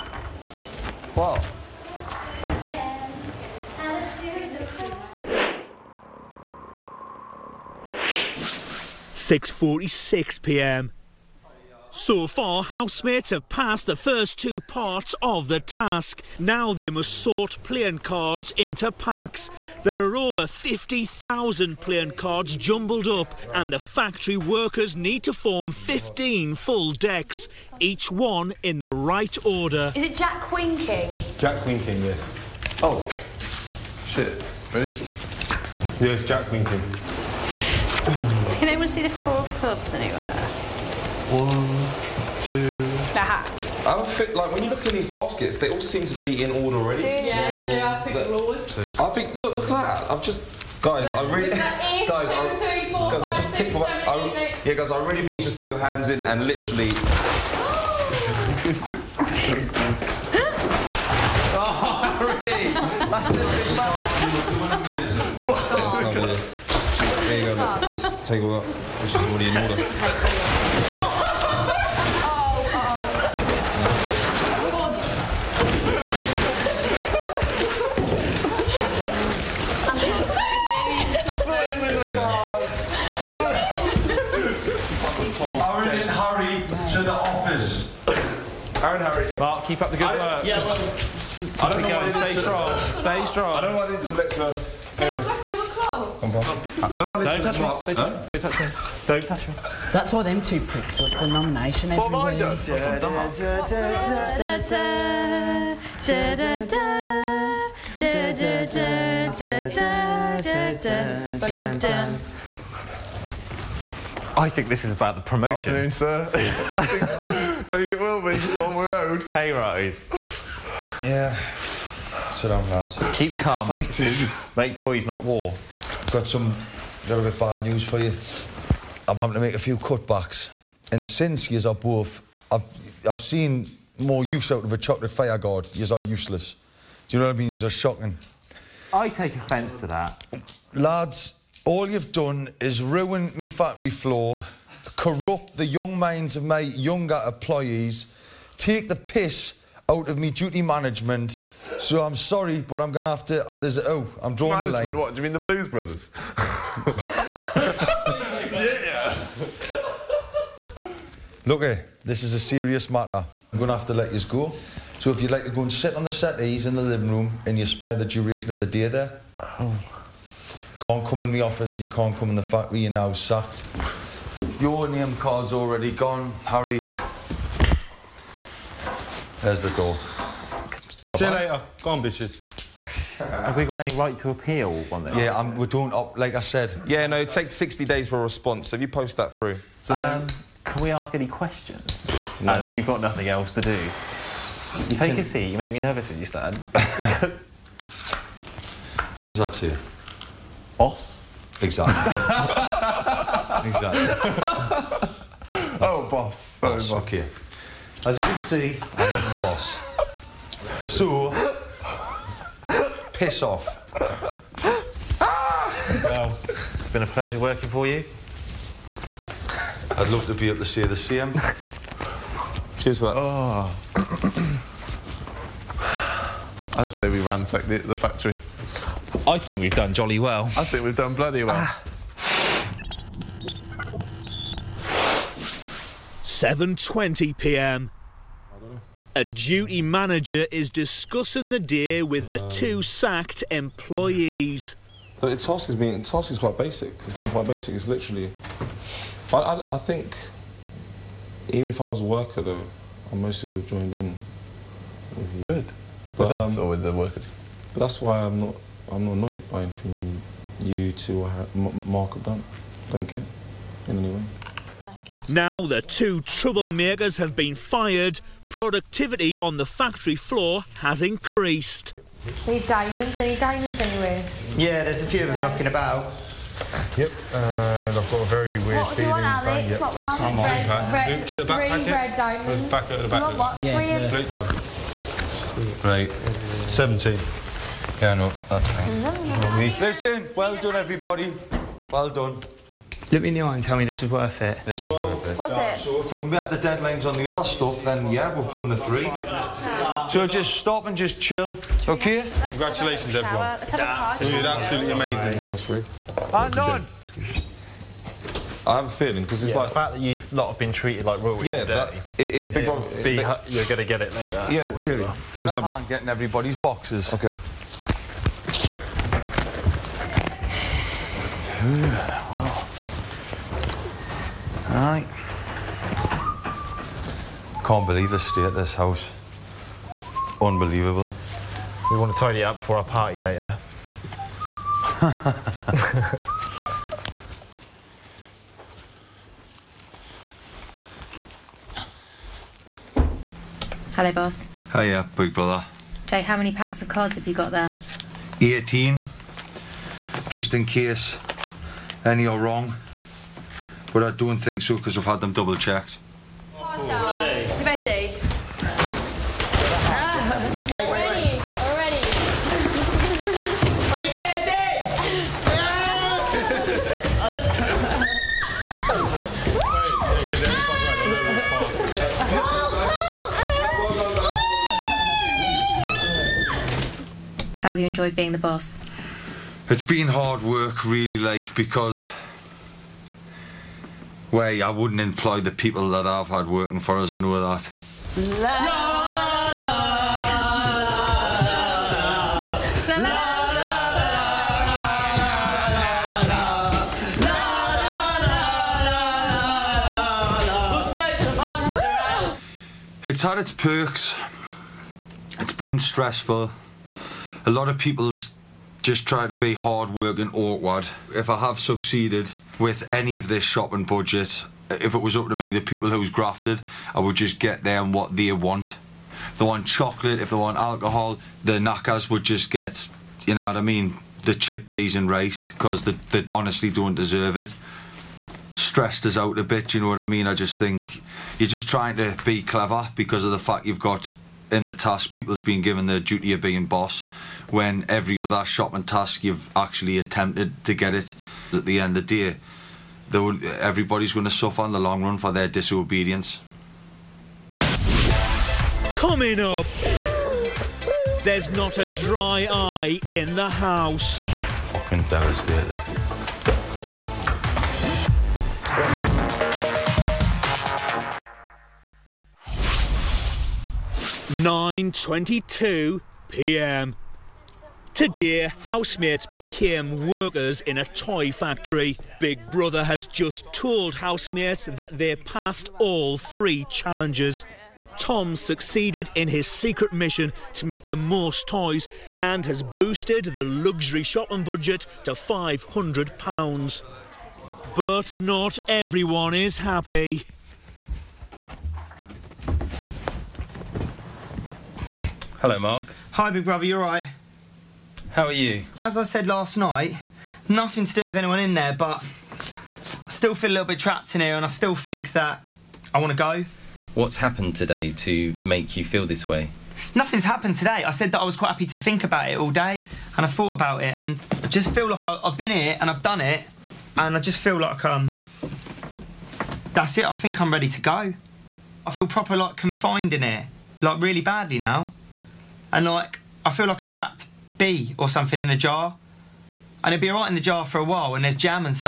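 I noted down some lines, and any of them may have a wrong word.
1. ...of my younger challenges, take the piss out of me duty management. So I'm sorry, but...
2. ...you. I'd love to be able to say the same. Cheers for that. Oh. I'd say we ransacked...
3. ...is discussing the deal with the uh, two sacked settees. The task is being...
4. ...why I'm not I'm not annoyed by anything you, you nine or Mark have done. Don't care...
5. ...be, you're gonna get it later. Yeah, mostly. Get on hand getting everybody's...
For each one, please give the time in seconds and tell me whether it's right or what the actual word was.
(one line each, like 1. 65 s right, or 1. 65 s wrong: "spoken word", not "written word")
1. 146 s wrong: "employees", not "challenges"
2. 217 s right
3. 240 s wrong: "employees", not "settees"
4. 258 s wrong: "two", not "nine"
5. 313 s wrong: "clearly", not "mostly".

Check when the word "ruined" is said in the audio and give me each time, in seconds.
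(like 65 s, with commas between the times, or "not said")
142 s.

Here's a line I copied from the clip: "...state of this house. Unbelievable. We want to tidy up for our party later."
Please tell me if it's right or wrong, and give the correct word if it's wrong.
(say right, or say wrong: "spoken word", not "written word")
right.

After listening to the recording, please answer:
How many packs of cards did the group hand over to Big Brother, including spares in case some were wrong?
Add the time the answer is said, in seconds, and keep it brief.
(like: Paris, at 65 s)
18, at 348 s.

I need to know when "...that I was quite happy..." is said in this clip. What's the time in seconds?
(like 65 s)
511 s.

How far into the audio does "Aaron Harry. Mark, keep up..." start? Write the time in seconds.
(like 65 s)
88 s.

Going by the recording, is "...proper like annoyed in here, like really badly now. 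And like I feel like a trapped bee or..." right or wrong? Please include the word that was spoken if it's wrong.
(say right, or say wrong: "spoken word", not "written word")
wrong: "confined", not "annoyed".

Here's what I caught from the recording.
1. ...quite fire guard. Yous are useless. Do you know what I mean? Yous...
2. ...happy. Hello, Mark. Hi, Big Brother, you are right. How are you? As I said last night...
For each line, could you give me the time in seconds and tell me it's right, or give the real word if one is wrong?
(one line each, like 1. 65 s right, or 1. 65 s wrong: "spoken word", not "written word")
1. 134 s wrong: "chocolate", not "quite"
2. 489 s right.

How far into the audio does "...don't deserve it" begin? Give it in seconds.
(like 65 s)
426 s.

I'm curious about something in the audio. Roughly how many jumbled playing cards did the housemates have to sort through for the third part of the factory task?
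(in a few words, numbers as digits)
over 50,000.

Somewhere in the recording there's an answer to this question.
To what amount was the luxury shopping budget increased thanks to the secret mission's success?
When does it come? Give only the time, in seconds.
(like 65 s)
485 s.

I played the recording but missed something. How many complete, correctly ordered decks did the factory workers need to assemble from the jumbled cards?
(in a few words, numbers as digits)
15.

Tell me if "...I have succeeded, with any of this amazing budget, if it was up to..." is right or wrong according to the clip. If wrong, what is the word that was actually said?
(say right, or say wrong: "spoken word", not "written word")
wrong: "shopping", not "amazing".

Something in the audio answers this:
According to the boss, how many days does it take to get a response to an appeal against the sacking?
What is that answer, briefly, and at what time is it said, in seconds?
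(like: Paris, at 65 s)
60 days, at 187 s.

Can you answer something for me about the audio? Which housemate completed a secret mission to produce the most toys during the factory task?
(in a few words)
Tom.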